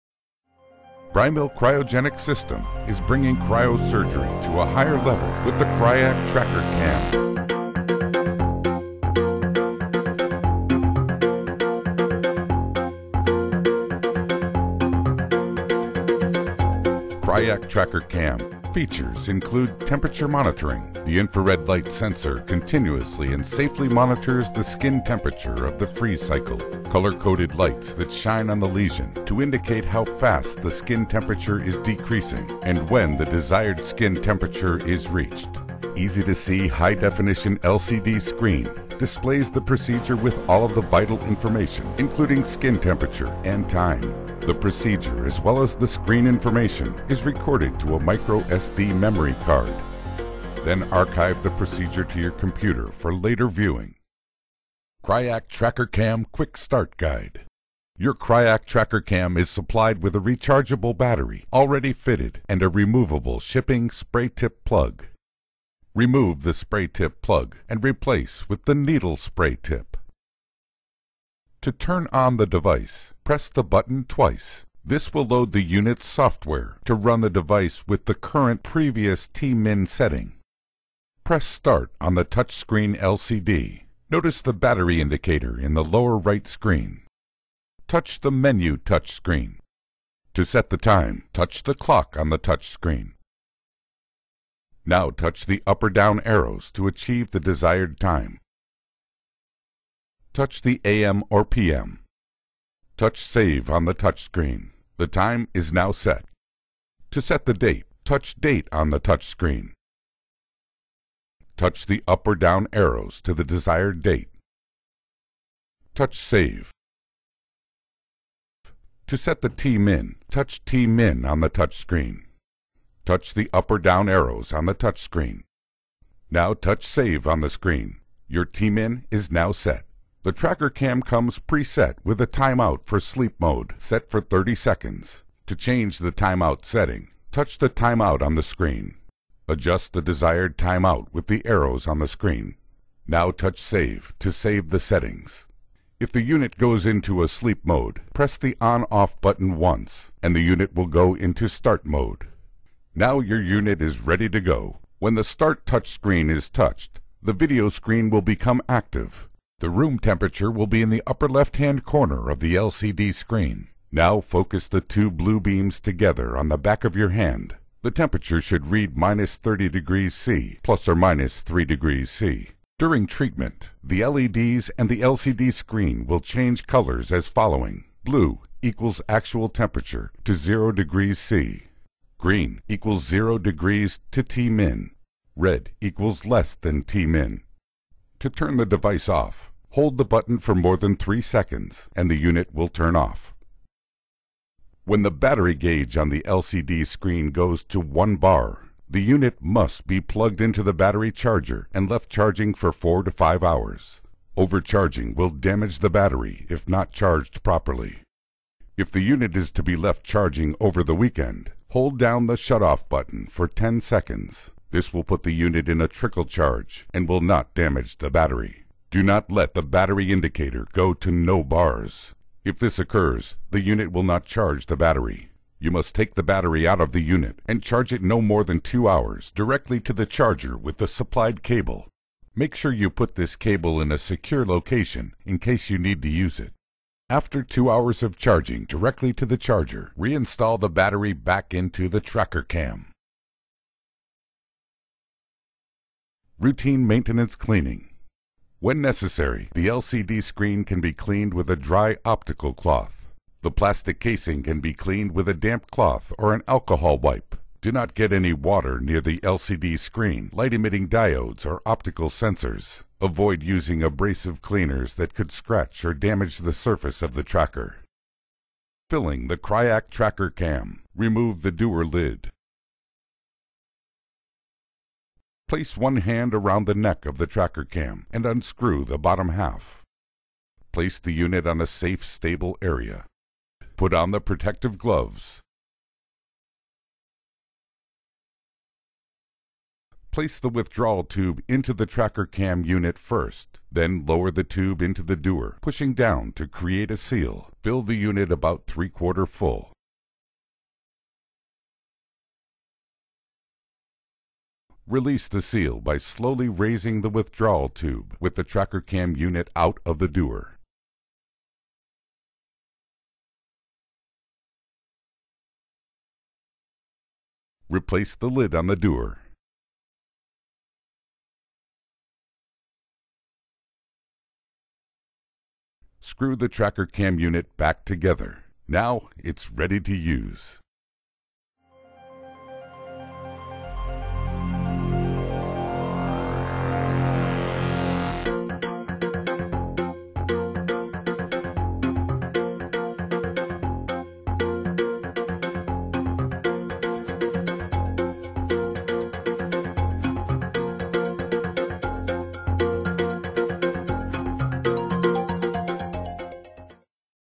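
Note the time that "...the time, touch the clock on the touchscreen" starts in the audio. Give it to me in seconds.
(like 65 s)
90 s.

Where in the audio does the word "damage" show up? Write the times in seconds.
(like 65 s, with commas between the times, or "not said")
205 s, 217 s, 265 s.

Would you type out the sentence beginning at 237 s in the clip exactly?
After two hours of charging directly to the charger, reinstall the battery back into the tracker cam.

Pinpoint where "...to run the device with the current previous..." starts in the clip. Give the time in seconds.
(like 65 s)
76 s.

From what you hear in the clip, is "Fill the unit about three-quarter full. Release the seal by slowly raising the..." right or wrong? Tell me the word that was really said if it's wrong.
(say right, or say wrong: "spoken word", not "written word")
right.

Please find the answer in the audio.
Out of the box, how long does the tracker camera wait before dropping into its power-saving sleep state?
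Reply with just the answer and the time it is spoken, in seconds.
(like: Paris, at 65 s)
30 seconds, at 134 s.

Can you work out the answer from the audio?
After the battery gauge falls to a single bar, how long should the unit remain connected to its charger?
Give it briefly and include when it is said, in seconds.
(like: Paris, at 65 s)
4 to 5 hours, at 202 s.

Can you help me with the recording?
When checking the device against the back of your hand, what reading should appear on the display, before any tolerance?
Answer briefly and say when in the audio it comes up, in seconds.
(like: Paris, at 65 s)
-30 degrees C, at 168 s.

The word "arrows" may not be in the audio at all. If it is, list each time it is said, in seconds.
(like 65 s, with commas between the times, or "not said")
96 s, 112 s, 124 s, 141 s.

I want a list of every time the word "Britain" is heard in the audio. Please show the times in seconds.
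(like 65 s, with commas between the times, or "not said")
not said.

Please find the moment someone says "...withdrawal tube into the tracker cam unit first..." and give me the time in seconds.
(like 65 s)
290 s.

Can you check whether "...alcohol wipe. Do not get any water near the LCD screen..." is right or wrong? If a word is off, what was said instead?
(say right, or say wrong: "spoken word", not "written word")
right.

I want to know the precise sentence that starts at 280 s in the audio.
Place the unit on a safe, stable area.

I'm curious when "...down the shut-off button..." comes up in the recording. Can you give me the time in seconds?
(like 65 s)
211 s.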